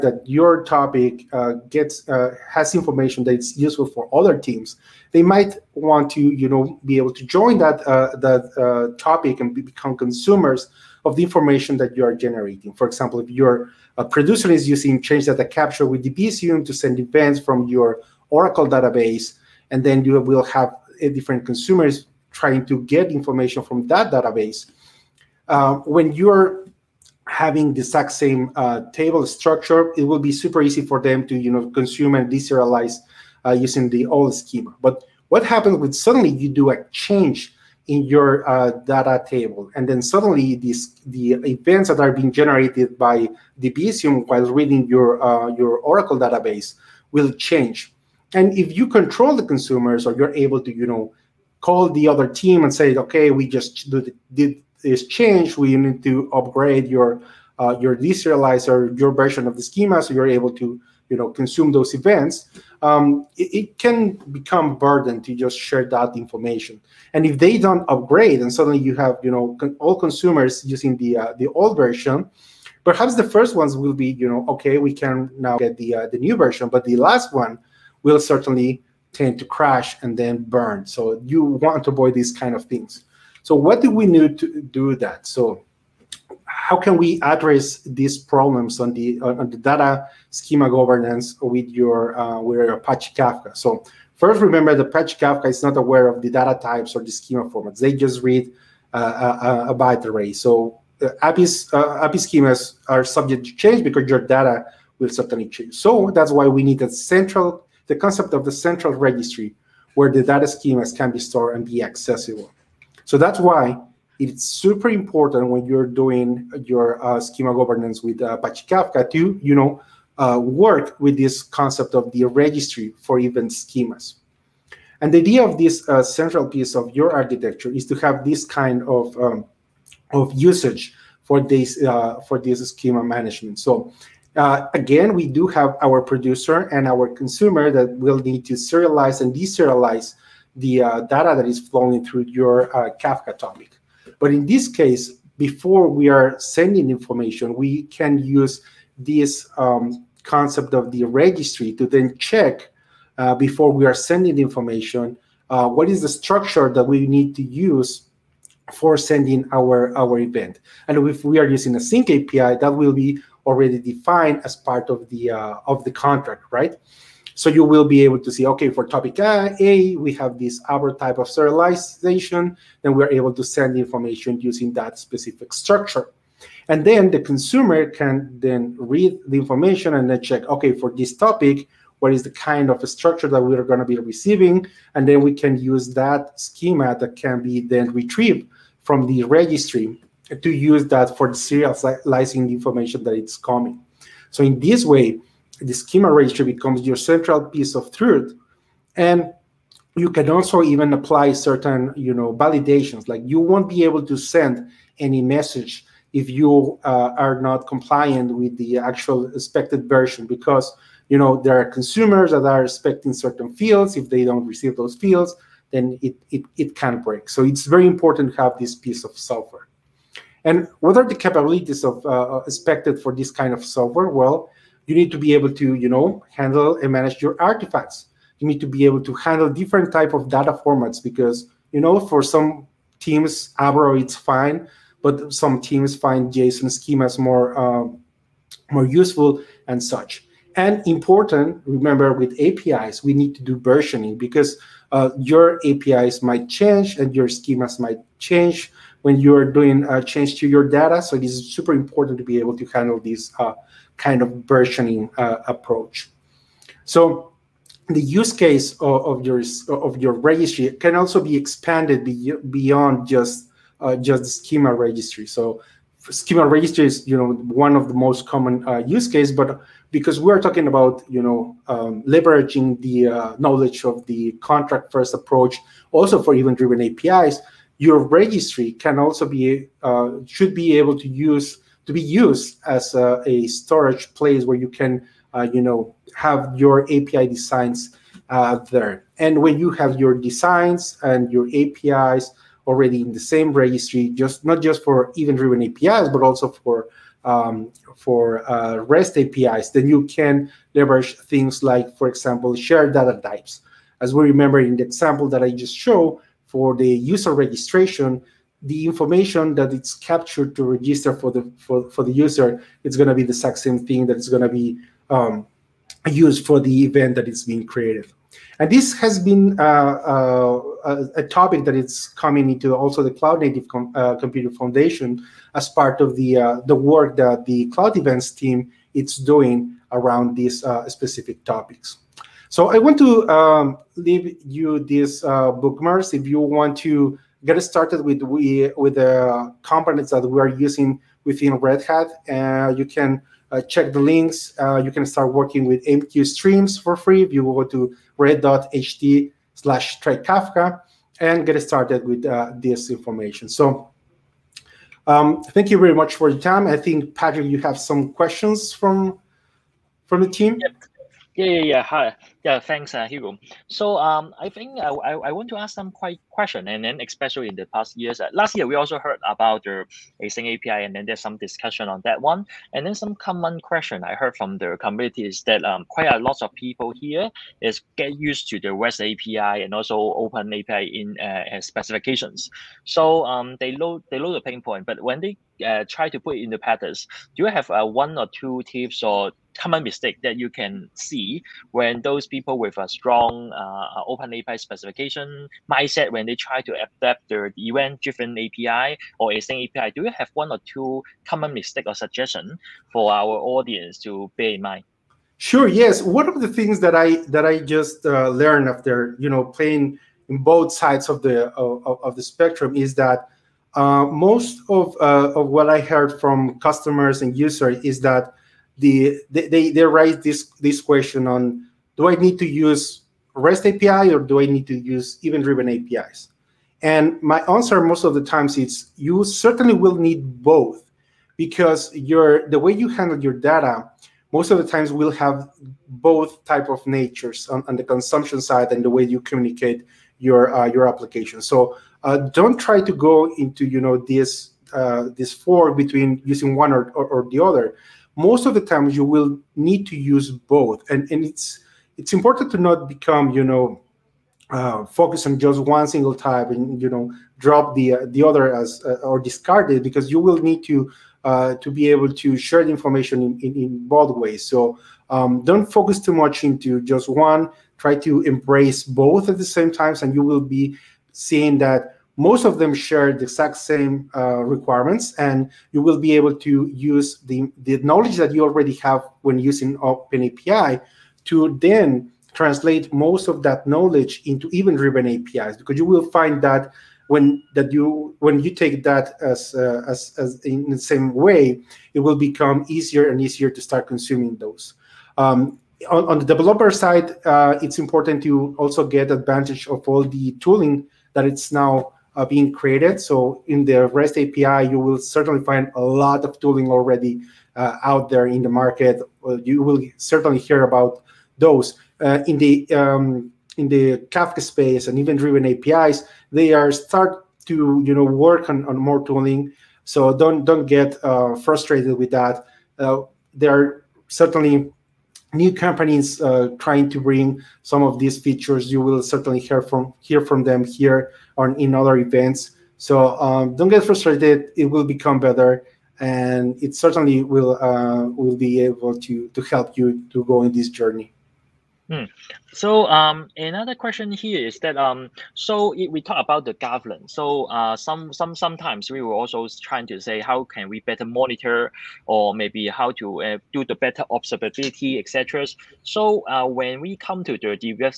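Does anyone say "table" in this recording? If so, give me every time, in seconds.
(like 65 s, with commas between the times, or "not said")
28 s, 39 s.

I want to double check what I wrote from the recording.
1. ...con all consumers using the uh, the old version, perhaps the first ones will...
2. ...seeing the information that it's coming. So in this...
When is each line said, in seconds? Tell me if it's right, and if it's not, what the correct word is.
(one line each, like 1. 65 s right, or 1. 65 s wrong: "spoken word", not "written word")
1. 69 s right
2. 191 s wrong: "serializing", not "seeing".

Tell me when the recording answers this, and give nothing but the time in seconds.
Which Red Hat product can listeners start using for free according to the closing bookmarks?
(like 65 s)
345 s.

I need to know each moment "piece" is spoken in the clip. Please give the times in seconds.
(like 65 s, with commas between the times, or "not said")
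126 s, 197 s, 218 s.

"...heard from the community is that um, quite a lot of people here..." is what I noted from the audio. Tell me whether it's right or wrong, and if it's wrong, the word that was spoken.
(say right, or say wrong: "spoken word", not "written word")
right.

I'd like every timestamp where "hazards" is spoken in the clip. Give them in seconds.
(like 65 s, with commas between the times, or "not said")
not said.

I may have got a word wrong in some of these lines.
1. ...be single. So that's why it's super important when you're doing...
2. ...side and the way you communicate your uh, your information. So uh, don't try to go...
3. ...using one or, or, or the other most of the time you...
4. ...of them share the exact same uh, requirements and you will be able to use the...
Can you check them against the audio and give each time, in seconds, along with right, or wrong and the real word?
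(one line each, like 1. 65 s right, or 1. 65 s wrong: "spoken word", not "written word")
1. 111 s wrong: "accessible", not "single"
2. 438 s wrong: "application", not "information"
3. 446 s right
4. 472 s right.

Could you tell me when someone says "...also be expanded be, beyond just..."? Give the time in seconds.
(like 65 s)
260 s.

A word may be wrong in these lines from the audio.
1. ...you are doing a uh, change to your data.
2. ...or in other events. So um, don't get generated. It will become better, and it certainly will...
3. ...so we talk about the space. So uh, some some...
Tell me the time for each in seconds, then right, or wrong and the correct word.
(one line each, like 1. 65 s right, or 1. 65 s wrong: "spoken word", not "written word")
1. 249 s right
2. 531 s wrong: "frustrated", not "generated"
3. 545 s wrong: "governance", not "space".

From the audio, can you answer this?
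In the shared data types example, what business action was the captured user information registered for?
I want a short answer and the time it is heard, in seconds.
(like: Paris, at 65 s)
user registration, at 306 s.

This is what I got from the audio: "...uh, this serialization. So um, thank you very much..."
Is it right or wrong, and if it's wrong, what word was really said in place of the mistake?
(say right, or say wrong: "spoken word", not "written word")
wrong: "information", not "serialization".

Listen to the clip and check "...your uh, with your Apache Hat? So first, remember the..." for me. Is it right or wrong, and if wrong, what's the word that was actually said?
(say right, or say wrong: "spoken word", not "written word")
wrong: "Kafka", not "Hat".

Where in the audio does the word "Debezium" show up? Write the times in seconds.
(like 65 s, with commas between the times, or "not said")
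16 s, 43 s.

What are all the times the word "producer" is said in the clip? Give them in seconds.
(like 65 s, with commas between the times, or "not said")
14 s, 135 s.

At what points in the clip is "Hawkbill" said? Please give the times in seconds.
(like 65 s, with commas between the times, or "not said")
not said.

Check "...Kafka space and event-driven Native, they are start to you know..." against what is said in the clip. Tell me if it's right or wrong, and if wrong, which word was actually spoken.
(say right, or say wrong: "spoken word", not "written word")
wrong: "APIs", not "Native".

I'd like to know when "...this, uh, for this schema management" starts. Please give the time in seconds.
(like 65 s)
131 s.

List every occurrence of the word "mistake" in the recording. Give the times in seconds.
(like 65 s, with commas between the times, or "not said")
389 s, 401 s.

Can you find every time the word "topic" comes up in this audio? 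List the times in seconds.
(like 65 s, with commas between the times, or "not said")
0 s, 8 s, 143 s, 168 s, 181 s, 321 s, 331 s.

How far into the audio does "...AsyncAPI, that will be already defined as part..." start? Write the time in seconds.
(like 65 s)
161 s.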